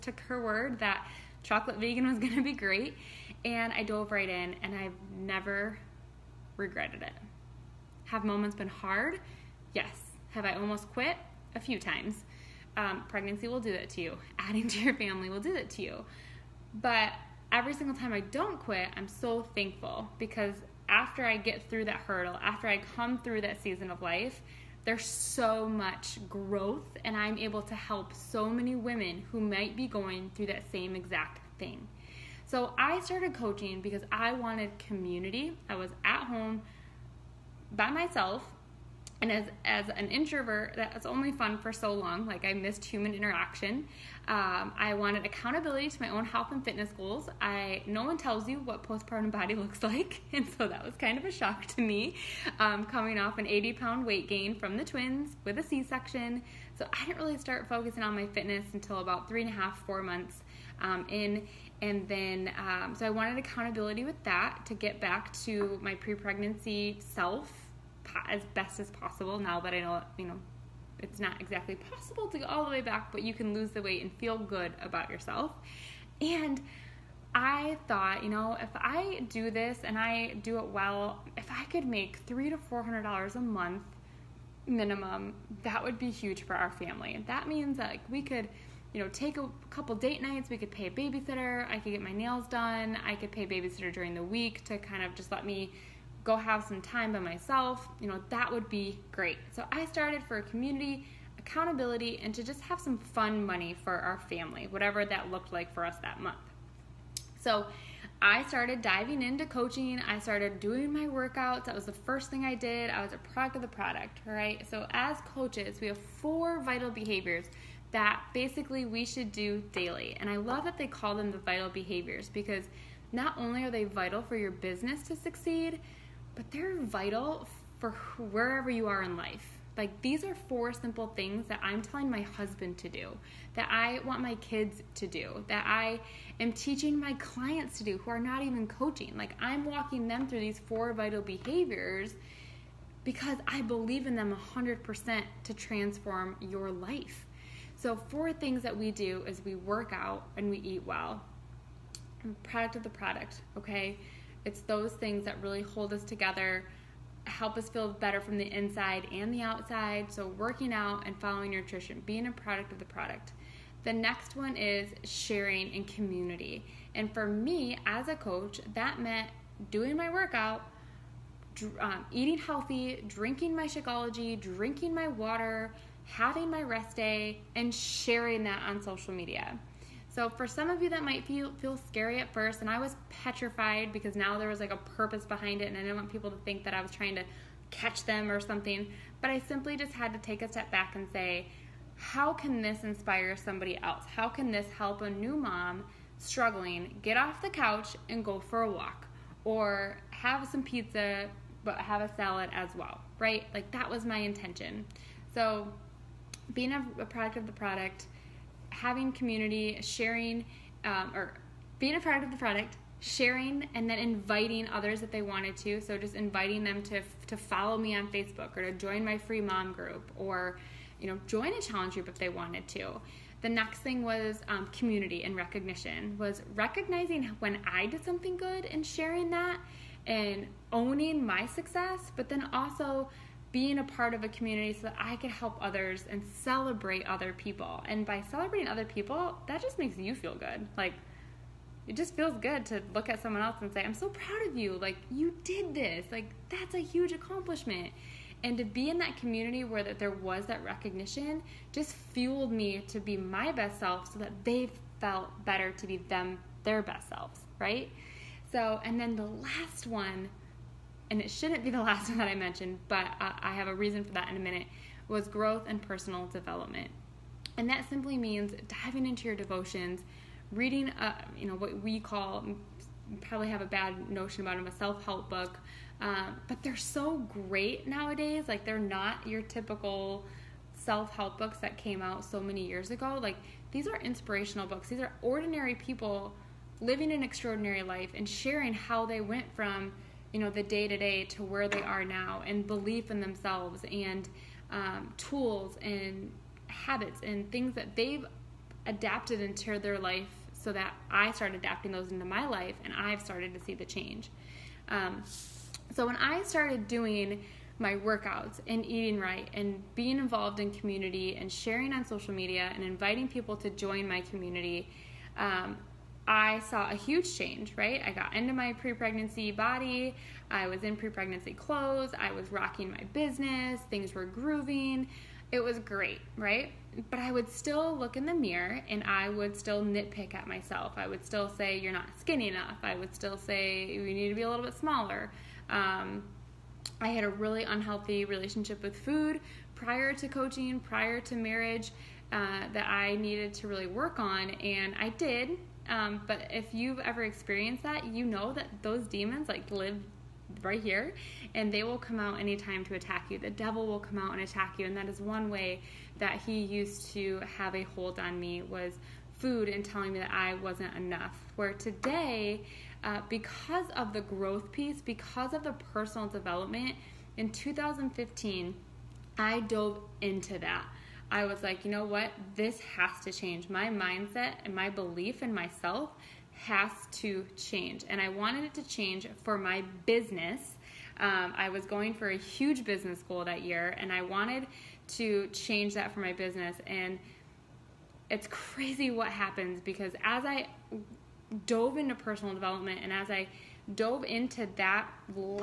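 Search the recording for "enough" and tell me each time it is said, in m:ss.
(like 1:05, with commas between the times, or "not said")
5:32, 6:00.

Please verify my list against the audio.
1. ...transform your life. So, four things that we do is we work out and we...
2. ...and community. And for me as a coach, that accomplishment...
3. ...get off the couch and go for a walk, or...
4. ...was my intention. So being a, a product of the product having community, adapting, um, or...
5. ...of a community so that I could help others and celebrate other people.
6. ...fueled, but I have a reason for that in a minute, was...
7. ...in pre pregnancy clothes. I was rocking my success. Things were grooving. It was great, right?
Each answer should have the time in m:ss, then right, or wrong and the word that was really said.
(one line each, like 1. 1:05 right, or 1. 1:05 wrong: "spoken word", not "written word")
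1. 2:25 right
2. 2:45 wrong: "meant", not "accomplishment"
3. 3:17 right
4. 3:23 wrong: "sharing", not "adapting"
5. 3:54 right
6. 4:22 wrong: "mentioned", not "fueled"
7. 5:20 wrong: "business", not "success".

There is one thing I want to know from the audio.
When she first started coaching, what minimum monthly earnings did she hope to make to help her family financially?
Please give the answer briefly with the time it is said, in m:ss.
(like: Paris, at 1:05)
$300 to $400, at 1:22.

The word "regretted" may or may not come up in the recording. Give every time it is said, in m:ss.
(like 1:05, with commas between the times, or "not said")
0:06.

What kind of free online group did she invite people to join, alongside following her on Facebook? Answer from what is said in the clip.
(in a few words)
Mom group.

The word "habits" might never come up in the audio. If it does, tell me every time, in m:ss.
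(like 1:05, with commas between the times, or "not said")
4:56.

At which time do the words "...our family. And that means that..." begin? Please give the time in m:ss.
1:26.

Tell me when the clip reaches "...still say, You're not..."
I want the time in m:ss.
5:31.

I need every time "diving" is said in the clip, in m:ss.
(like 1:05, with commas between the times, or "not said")
1:48, 4:28.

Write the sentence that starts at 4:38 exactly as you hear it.
Like they're not your typical self-help books that came out so many years ago.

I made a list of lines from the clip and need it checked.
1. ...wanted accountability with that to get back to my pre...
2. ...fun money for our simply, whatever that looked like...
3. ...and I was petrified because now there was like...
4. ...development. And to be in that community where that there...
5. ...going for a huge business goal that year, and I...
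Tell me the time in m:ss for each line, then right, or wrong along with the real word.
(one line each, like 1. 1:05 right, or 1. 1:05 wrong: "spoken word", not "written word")
1. 1:03 right
2. 1:42 wrong: "family", not "simply"
3. 3:02 right
4. 4:07 wrong: "accomplishment", not "development"
5. 6:21 right.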